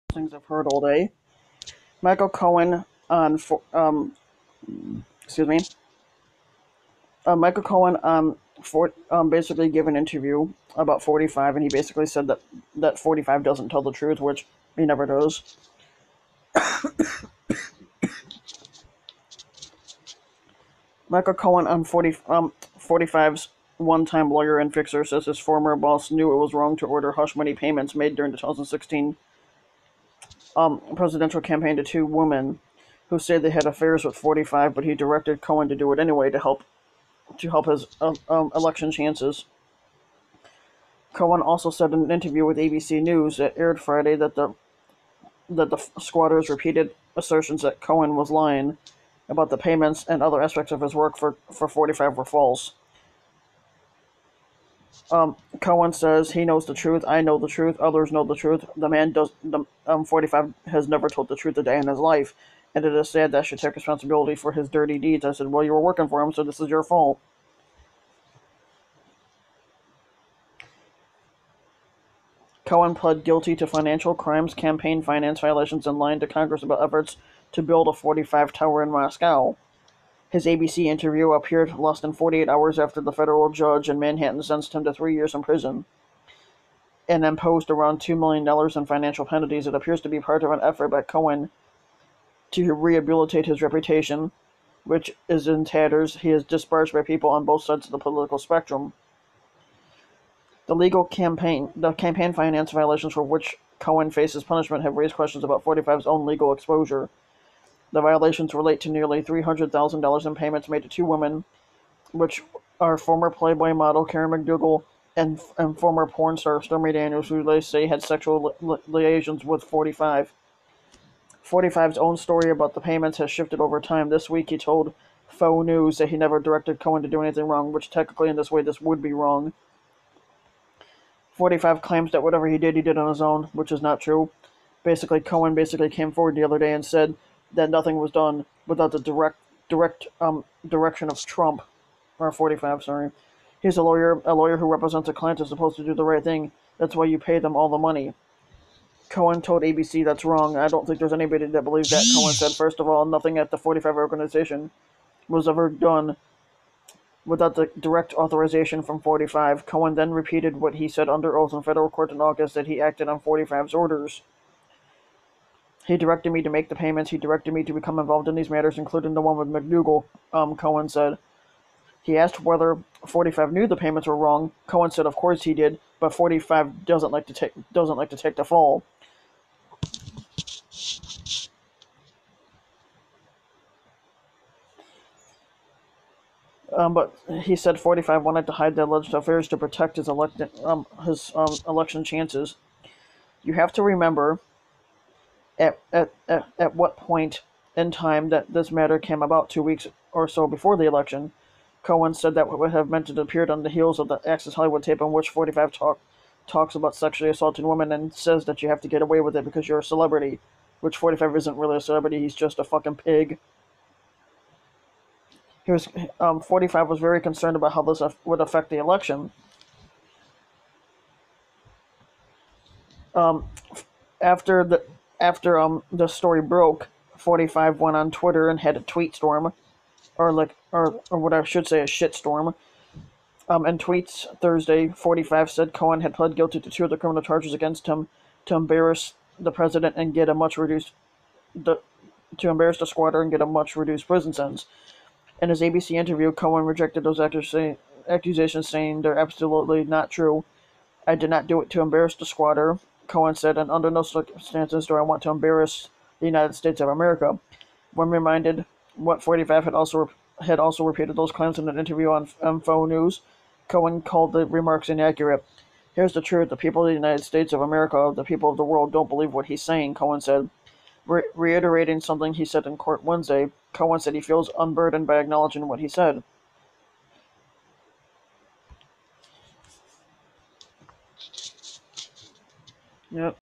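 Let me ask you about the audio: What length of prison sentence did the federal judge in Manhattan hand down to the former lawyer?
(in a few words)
3 years.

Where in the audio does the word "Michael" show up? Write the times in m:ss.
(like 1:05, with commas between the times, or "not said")
0:02, 0:07, 0:21.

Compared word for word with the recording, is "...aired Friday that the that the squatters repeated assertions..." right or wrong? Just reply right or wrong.
right.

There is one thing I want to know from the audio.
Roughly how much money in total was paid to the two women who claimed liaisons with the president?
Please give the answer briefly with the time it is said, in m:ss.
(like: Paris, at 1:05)
nearly $300,000, at 1:48.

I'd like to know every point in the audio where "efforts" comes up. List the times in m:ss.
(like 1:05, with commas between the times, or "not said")
1:16, 1:30.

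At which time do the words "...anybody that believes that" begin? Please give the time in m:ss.
2:31.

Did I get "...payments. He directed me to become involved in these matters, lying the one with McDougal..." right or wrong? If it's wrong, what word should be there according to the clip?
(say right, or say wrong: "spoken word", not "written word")
wrong: "including", not "lying".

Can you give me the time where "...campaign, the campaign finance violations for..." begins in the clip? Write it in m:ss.
1:41.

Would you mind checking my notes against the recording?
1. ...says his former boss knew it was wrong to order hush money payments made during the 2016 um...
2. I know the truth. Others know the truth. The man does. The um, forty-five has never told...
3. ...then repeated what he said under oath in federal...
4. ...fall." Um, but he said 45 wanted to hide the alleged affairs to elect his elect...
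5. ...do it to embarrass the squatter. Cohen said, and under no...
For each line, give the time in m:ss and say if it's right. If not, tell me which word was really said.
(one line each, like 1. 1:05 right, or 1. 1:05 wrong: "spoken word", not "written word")
1. 0:25 right
2. 0:57 right
3. 2:39 right
4. 2:58 wrong: "protect", not "elect"
5. 4:11 right.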